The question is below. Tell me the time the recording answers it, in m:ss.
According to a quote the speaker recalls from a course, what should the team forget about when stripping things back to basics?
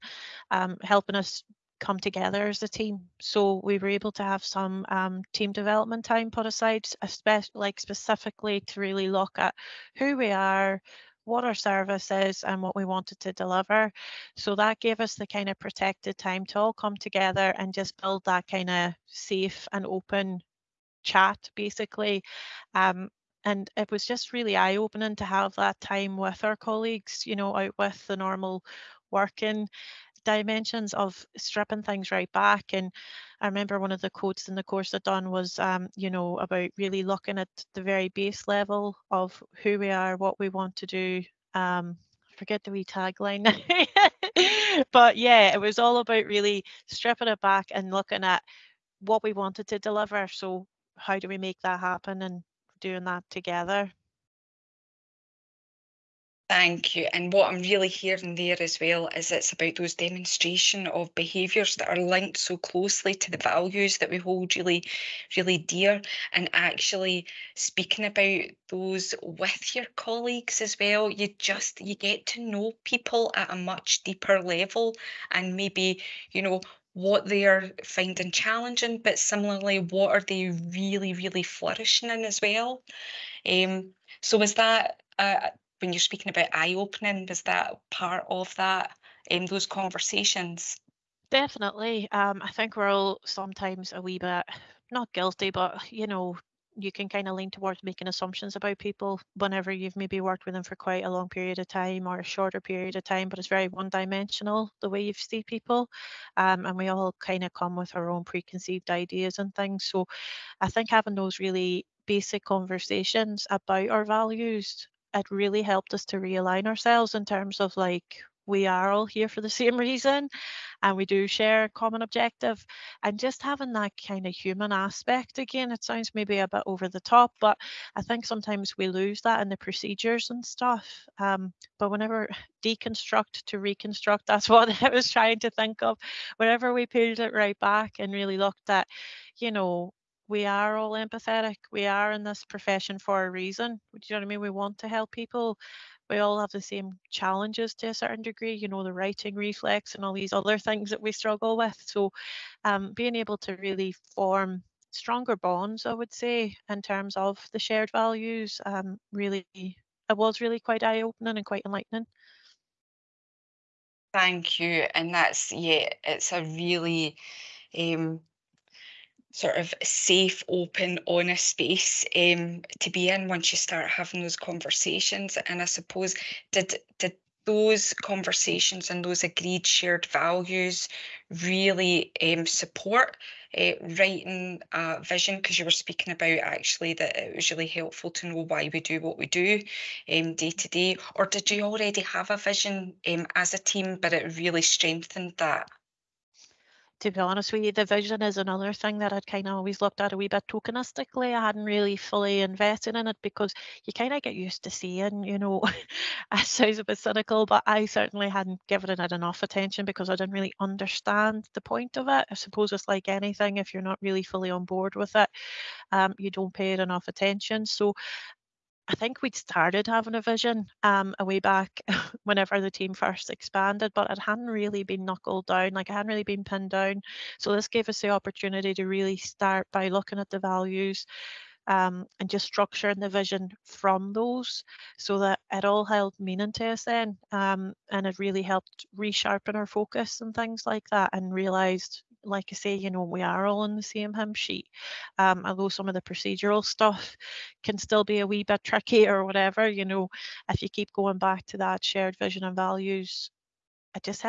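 0:42.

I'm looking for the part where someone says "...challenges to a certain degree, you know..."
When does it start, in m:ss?
2:27.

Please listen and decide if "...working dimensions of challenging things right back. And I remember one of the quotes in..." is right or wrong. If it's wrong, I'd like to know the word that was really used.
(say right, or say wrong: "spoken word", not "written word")
wrong: "stripping", not "challenging".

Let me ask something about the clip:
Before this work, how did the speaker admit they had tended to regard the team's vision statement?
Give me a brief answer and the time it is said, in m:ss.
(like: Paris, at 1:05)
tokenistically, at 3:20.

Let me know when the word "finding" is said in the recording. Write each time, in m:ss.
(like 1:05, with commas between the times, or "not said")
1:17.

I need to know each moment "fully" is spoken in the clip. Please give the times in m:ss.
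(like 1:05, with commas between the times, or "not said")
3:21, 3:34.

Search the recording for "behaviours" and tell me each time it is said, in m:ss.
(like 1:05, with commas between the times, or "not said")
1:01.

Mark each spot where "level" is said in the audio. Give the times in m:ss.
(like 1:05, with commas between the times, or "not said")
0:38, 1:14.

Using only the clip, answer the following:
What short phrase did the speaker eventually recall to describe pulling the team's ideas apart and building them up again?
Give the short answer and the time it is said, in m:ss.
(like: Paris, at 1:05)
deconstruct to reconstruct, at 2:12.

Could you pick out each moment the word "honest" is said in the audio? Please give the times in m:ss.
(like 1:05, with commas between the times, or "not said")
2:51, 3:17.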